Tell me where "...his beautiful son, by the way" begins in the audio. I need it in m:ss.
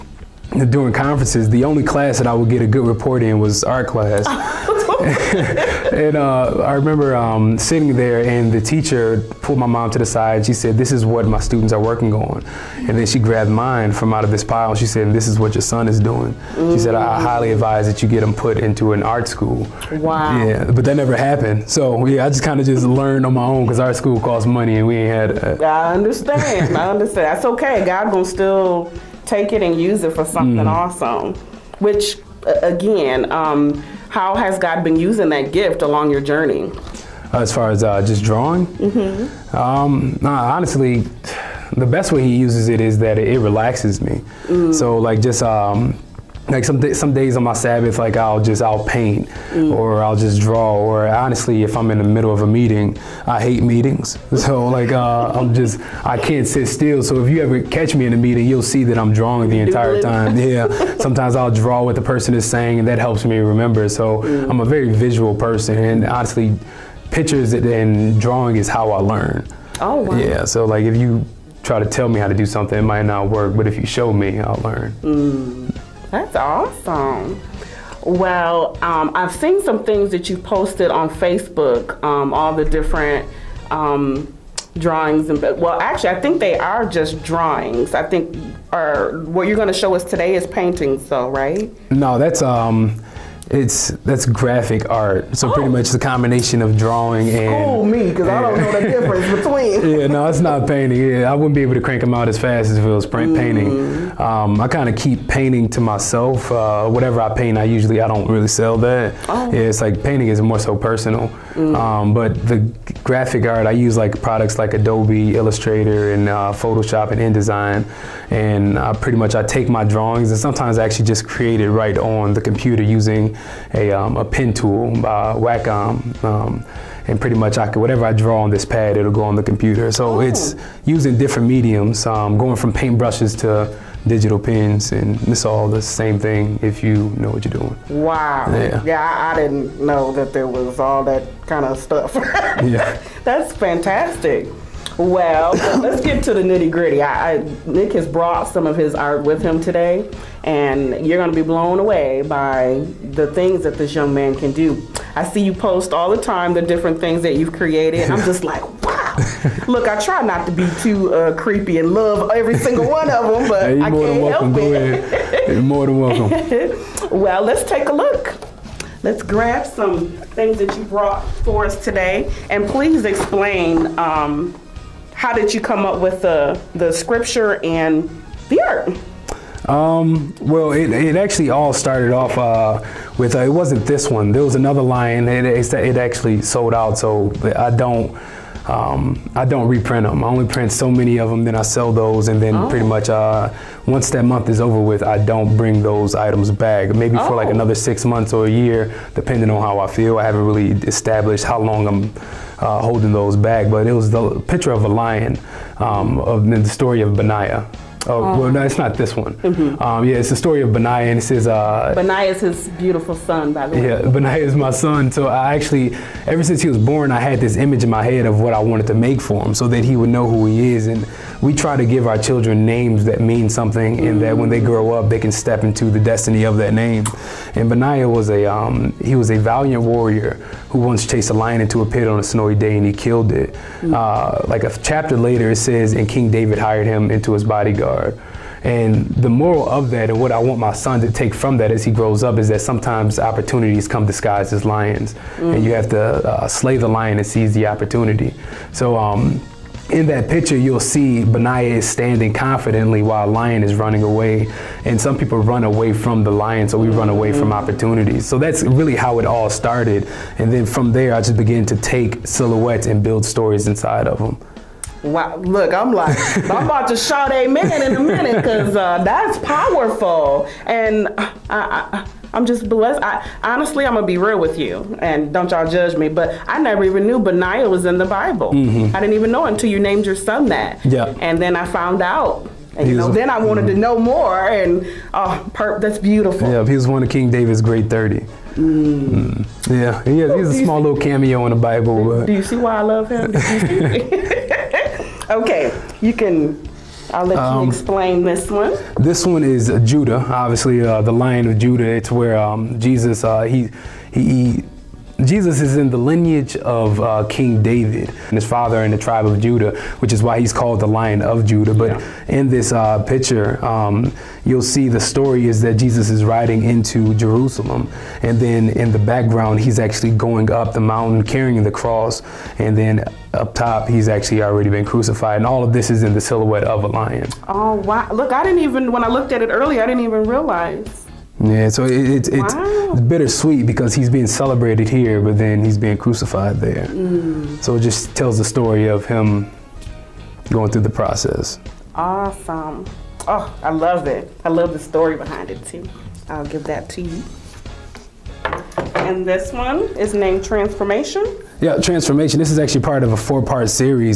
3:32.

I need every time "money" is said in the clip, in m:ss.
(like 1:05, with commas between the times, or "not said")
0:24.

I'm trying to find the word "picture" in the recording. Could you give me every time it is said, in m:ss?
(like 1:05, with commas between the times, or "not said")
1:07, 3:24, 4:10, 5:13.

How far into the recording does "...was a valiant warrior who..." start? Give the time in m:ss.
3:49.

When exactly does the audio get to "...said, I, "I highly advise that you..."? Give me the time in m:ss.
0:16.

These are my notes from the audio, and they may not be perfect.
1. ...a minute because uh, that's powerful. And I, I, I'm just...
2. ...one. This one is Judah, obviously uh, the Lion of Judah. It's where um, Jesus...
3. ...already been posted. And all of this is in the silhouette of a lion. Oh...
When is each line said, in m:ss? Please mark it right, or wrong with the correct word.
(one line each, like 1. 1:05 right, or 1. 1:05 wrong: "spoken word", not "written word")
1. 4:27 right
2. 4:58 right
3. 5:24 wrong: "crucified", not "posted".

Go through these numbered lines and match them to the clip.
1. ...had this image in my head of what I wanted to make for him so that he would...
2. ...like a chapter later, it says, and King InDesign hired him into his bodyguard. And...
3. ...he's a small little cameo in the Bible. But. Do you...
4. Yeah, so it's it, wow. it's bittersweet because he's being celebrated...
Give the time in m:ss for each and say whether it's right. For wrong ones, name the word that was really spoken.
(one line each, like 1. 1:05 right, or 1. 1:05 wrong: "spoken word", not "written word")
1. 3:37 right
2. 3:54 wrong: "David", not "InDesign"
3. 4:50 right
4. 5:31 right.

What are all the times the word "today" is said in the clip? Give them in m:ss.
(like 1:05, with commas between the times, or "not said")
1:30, 2:29, 2:51.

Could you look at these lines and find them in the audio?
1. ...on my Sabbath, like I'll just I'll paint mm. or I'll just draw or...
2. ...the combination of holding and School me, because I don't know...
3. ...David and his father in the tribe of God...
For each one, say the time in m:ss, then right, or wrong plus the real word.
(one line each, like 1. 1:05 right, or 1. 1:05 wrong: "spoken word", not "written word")
1. 0:47 right
2. 1:35 wrong: "drawing", not "holding"
3. 5:07 wrong: "Judah", not "God".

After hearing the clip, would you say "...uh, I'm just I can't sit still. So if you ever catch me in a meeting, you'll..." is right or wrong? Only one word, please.
right.